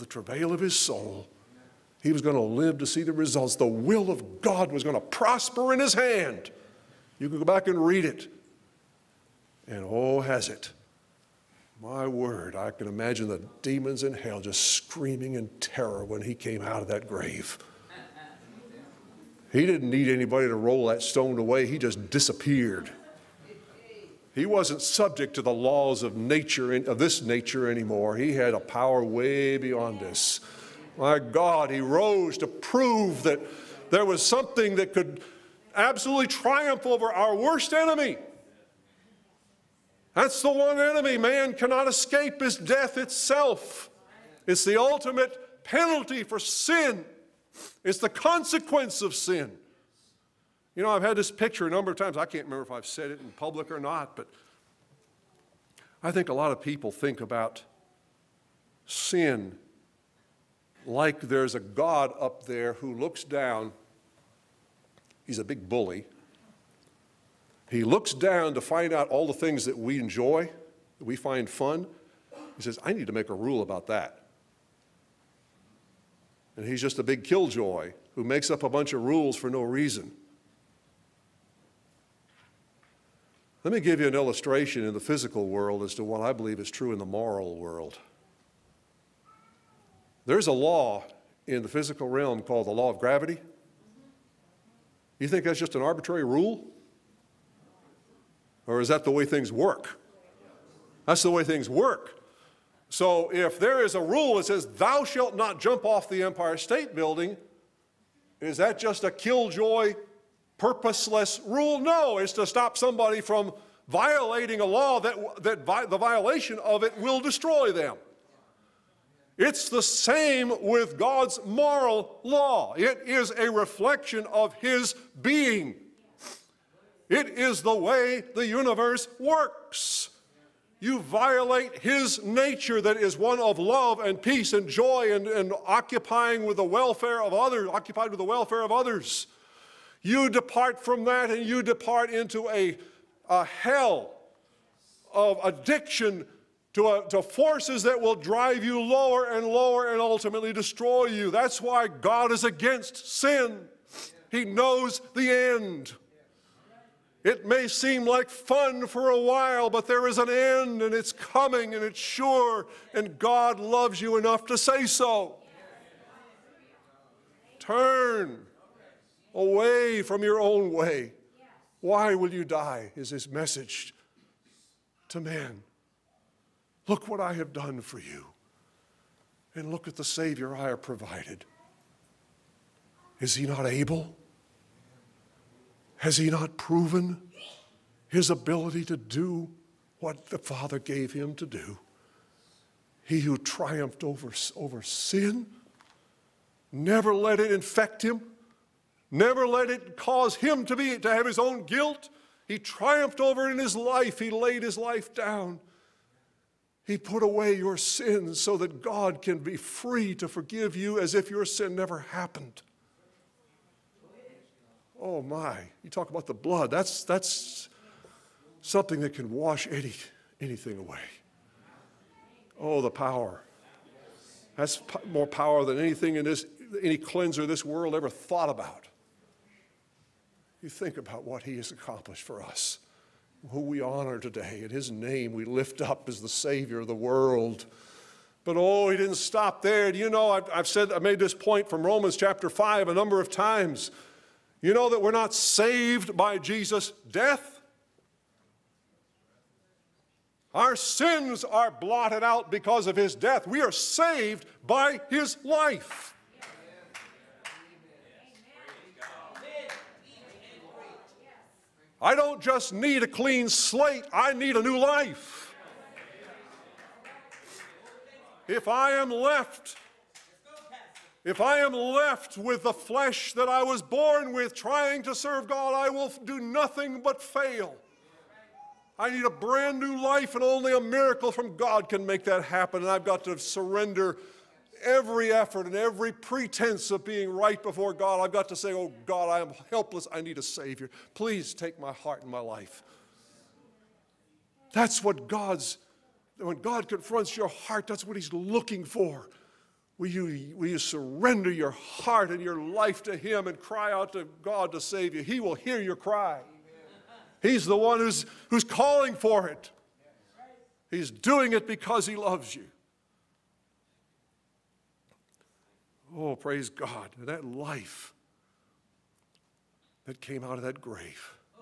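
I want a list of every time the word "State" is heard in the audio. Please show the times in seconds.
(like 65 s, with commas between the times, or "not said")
106 s.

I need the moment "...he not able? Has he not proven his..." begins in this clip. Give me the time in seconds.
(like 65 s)
183 s.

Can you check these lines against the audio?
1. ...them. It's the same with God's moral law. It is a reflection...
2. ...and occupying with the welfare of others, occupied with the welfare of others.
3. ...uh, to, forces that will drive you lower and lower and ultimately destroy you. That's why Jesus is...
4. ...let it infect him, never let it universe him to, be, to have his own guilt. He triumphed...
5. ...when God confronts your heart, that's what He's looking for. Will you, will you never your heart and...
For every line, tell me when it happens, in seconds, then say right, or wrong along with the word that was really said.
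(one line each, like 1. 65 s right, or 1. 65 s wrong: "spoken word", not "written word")
1. 117 s right
2. 135 s right
3. 146 s wrong: "God", not "Jesus"
4. 197 s wrong: "cause", not "universe"
5. 296 s wrong: "surrender", not "never".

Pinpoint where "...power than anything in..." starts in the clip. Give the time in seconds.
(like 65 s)
225 s.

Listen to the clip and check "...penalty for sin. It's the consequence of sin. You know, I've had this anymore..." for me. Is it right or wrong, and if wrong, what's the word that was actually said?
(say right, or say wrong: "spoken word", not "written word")
wrong: "picture", not "anymore".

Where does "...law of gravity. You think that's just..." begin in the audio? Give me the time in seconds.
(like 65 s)
92 s.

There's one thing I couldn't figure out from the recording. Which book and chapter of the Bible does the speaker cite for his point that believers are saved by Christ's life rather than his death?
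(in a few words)
Romans chapter 5.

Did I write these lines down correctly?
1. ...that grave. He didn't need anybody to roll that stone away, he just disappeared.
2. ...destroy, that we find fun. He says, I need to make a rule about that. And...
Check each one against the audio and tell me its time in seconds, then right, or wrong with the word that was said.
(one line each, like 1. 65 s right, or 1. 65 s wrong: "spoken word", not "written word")
1. 16 s right
2. 69 s wrong: "enjoy", not "destroy".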